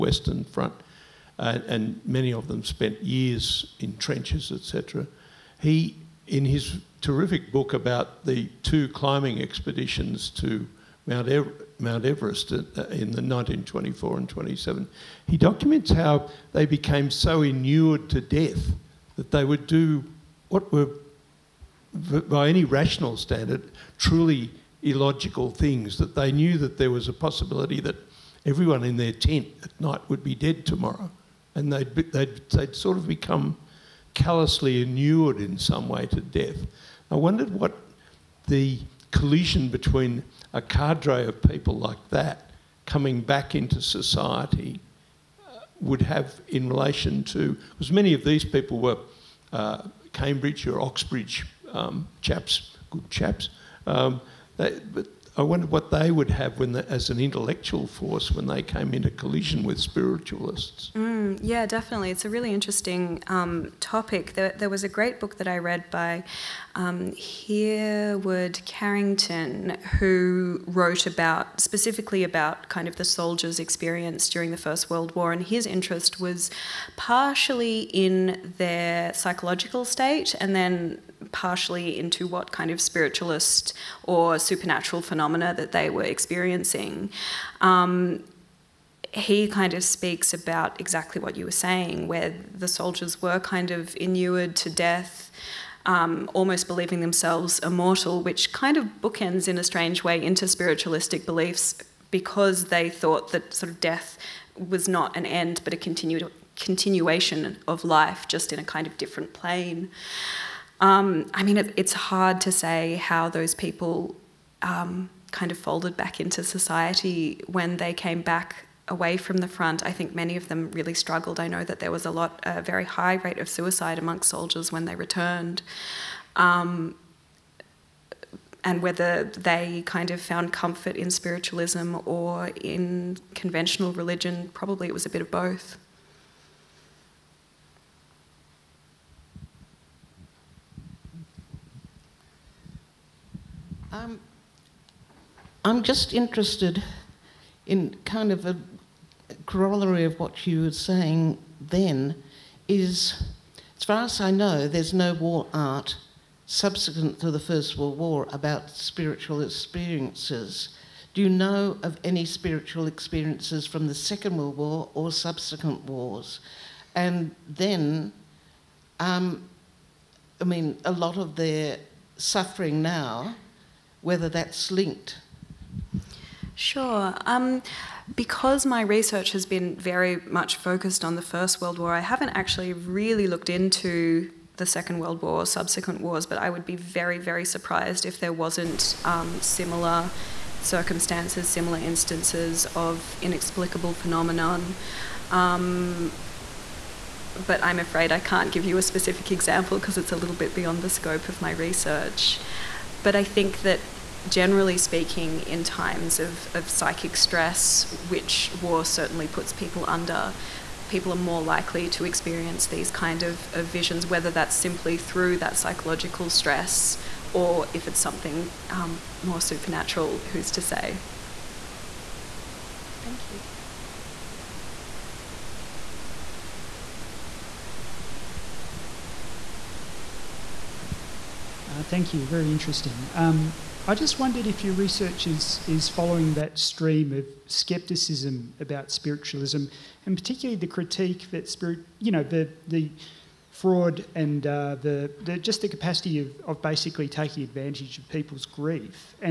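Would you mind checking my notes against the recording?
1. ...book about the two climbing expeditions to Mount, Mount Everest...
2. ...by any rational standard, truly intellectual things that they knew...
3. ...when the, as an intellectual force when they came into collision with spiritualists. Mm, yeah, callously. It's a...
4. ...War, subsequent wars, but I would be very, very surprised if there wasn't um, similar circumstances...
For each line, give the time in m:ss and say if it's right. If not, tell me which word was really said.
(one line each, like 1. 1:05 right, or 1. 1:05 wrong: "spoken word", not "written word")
1. 0:07 right
2. 0:22 wrong: "illogical", not "intellectual"
3. 0:56 wrong: "definitely", not "callously"
4. 3:05 right.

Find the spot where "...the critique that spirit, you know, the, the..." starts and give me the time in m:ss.
4:00.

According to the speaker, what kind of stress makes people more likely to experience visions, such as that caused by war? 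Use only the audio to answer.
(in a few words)
Psychic stress.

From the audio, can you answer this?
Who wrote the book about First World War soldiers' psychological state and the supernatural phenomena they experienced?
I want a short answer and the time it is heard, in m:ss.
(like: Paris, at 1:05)
Hereward Carrington, at 1:07.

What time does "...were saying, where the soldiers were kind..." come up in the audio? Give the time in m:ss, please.
1:31.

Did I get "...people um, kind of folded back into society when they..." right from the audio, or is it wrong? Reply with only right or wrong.
right.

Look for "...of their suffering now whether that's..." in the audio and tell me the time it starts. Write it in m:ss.
2:51.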